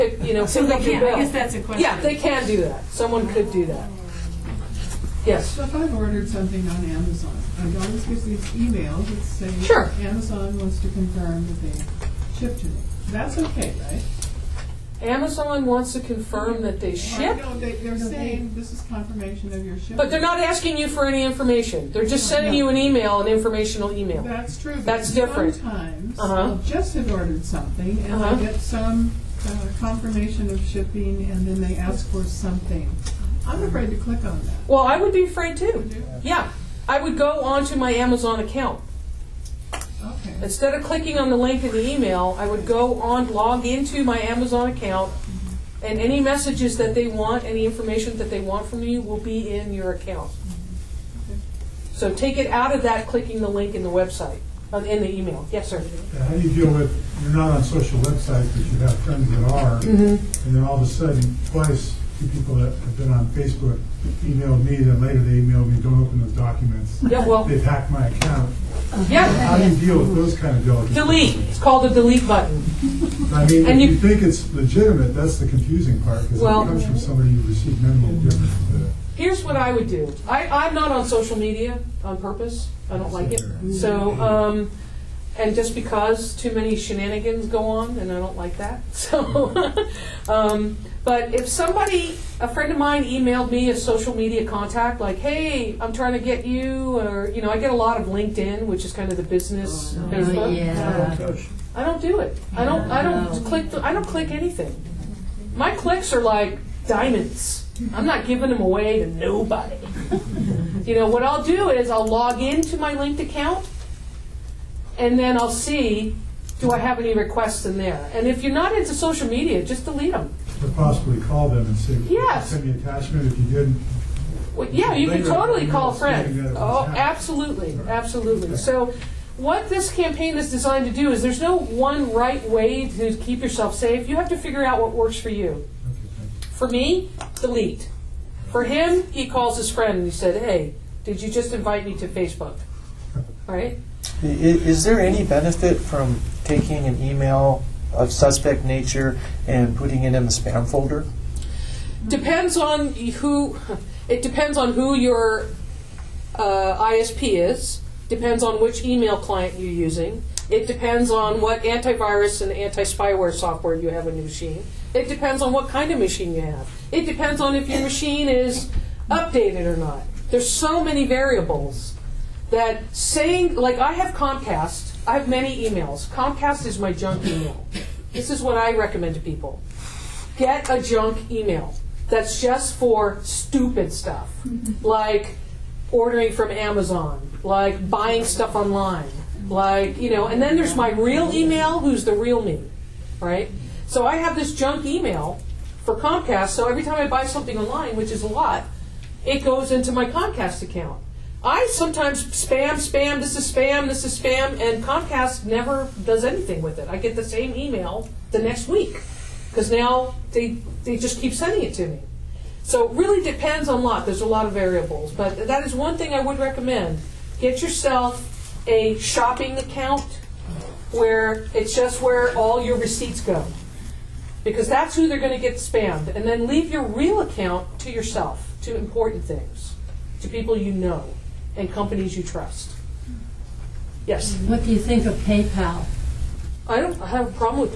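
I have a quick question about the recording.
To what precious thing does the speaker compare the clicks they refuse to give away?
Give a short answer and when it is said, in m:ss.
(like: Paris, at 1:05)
diamonds, at 1:46.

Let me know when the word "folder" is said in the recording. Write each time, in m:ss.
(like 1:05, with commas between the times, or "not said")
2:30.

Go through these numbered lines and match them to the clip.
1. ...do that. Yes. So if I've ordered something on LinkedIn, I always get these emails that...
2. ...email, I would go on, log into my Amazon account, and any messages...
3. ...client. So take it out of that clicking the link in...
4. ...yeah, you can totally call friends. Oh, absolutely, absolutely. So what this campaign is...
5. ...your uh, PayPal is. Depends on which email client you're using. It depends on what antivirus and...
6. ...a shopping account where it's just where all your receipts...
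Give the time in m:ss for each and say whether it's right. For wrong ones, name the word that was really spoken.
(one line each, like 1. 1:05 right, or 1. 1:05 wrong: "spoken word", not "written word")
1. 0:03 wrong: "Amazon", not "LinkedIn"
2. 0:41 right
3. 0:49 wrong: "account", not "client"
4. 2:04 right
5. 2:34 wrong: "ISP", not "PayPal"
6. 3:38 right.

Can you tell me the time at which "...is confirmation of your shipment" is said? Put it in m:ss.
0:18.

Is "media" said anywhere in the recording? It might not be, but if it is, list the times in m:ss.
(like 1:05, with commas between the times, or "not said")
1:21, 1:34, 1:59.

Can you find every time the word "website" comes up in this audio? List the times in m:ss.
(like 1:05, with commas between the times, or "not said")
0:53, 0:57.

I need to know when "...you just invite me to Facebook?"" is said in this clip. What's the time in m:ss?
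2:21.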